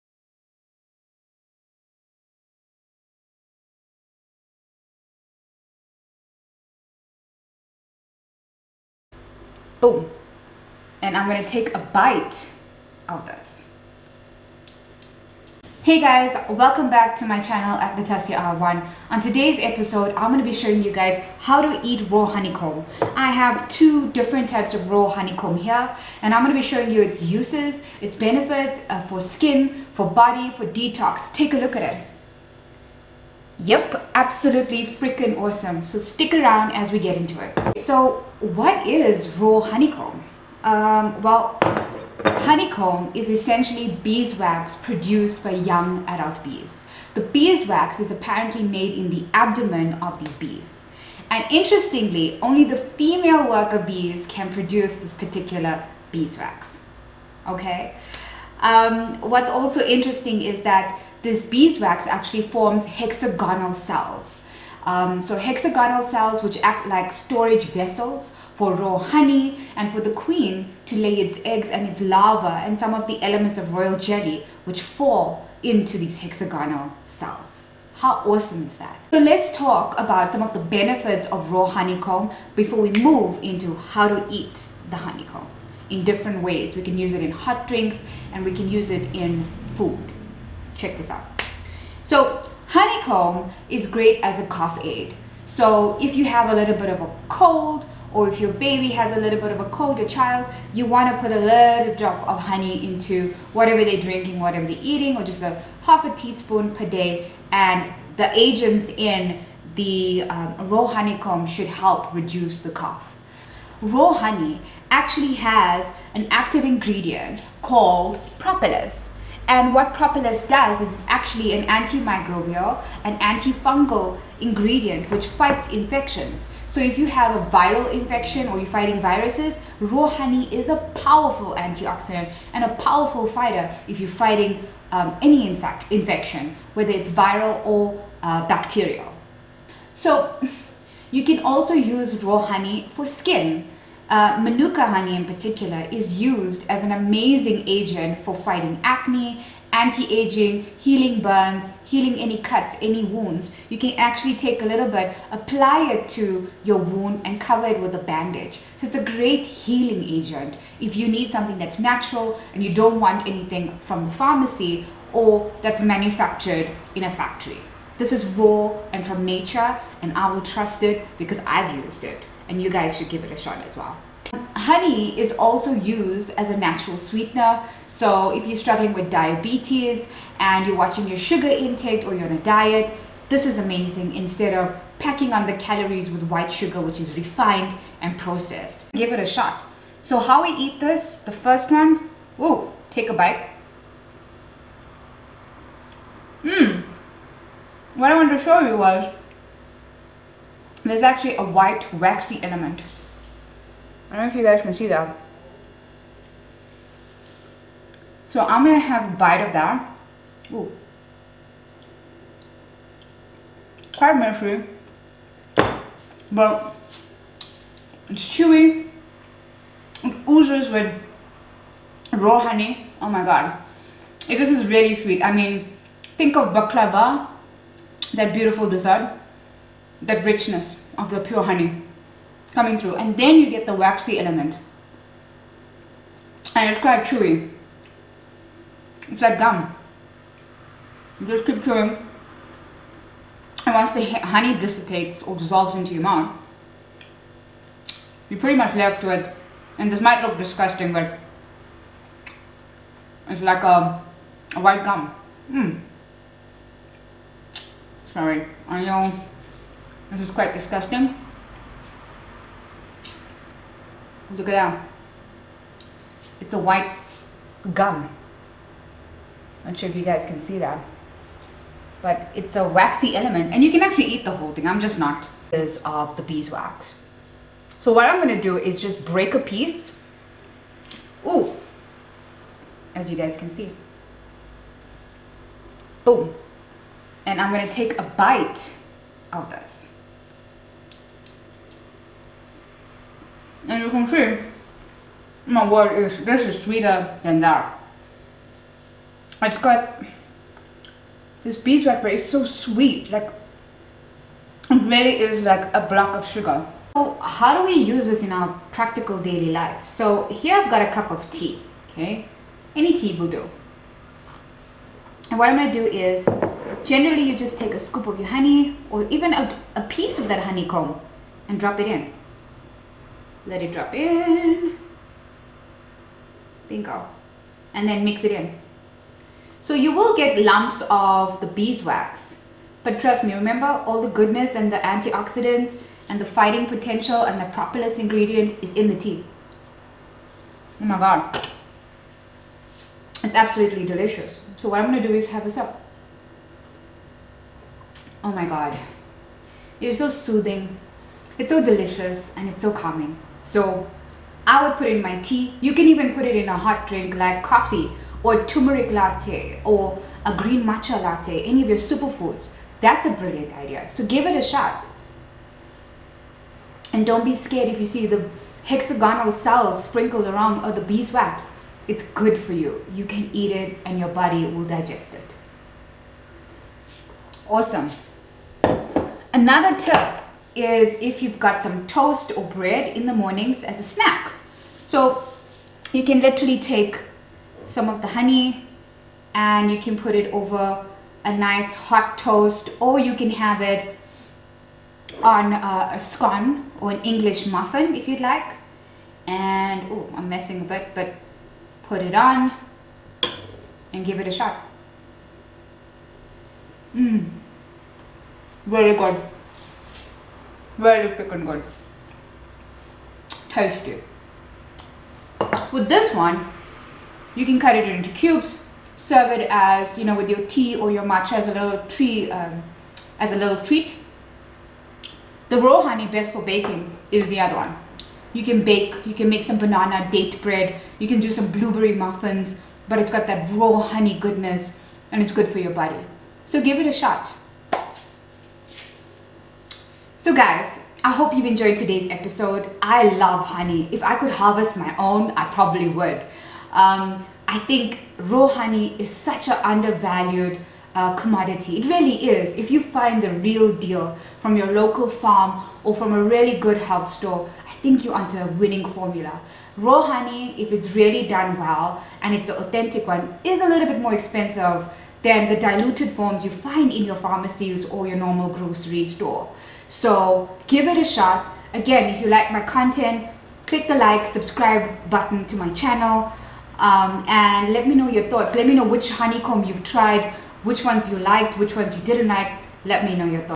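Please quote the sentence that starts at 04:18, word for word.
sorry I know this is quite disgusting.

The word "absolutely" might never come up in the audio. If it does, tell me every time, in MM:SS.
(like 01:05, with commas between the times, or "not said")
00:34, 05:43.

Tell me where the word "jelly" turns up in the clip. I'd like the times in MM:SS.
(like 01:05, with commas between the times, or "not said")
01:13.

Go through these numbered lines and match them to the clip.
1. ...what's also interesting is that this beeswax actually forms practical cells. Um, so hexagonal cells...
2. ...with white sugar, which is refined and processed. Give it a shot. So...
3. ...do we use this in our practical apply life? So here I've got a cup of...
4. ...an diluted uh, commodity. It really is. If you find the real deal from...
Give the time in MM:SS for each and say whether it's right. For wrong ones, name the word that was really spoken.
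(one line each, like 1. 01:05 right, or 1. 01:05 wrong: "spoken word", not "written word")
1. 00:59 wrong: "hexagonal", not "practical"
2. 03:06 right
3. 05:07 wrong: "daily", not "apply"
4. 07:29 wrong: "undervalued", not "diluted".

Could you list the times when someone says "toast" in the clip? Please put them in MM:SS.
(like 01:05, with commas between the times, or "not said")
06:21, 06:32.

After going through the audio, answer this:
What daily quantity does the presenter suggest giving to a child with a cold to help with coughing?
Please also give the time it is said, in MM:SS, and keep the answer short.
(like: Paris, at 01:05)
half a teaspoon, at 01:45.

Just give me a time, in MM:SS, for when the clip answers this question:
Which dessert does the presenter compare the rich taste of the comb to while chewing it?
03:46.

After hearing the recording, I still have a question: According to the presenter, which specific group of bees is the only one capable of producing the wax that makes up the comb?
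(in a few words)
female worker bees.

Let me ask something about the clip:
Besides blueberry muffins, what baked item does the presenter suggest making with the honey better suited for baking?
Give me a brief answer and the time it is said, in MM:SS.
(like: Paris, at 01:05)
banana date bread, at 07:09.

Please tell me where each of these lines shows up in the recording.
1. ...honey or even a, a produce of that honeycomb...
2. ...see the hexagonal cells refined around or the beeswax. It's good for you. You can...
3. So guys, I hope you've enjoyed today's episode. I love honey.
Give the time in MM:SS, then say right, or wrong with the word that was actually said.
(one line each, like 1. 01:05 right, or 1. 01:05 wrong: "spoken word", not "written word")
1. 05:18 wrong: "piece", not "produce"
2. 06:07 wrong: "sprinkled", not "refined"
3. 07:20 right.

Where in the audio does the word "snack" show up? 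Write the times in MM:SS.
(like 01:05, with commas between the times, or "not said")
06:23.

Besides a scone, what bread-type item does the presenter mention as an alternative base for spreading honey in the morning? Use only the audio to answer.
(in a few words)
English muffin.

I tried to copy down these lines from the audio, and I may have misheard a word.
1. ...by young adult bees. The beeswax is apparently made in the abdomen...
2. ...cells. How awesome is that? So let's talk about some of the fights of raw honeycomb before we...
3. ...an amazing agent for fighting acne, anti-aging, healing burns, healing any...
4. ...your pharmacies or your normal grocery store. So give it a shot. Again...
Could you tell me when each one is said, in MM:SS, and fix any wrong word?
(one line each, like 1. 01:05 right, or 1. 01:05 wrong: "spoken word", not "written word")
1. 00:45 right
2. 01:17 wrong: "benefits", not "fights"
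3. 02:26 right
4. 07:47 right.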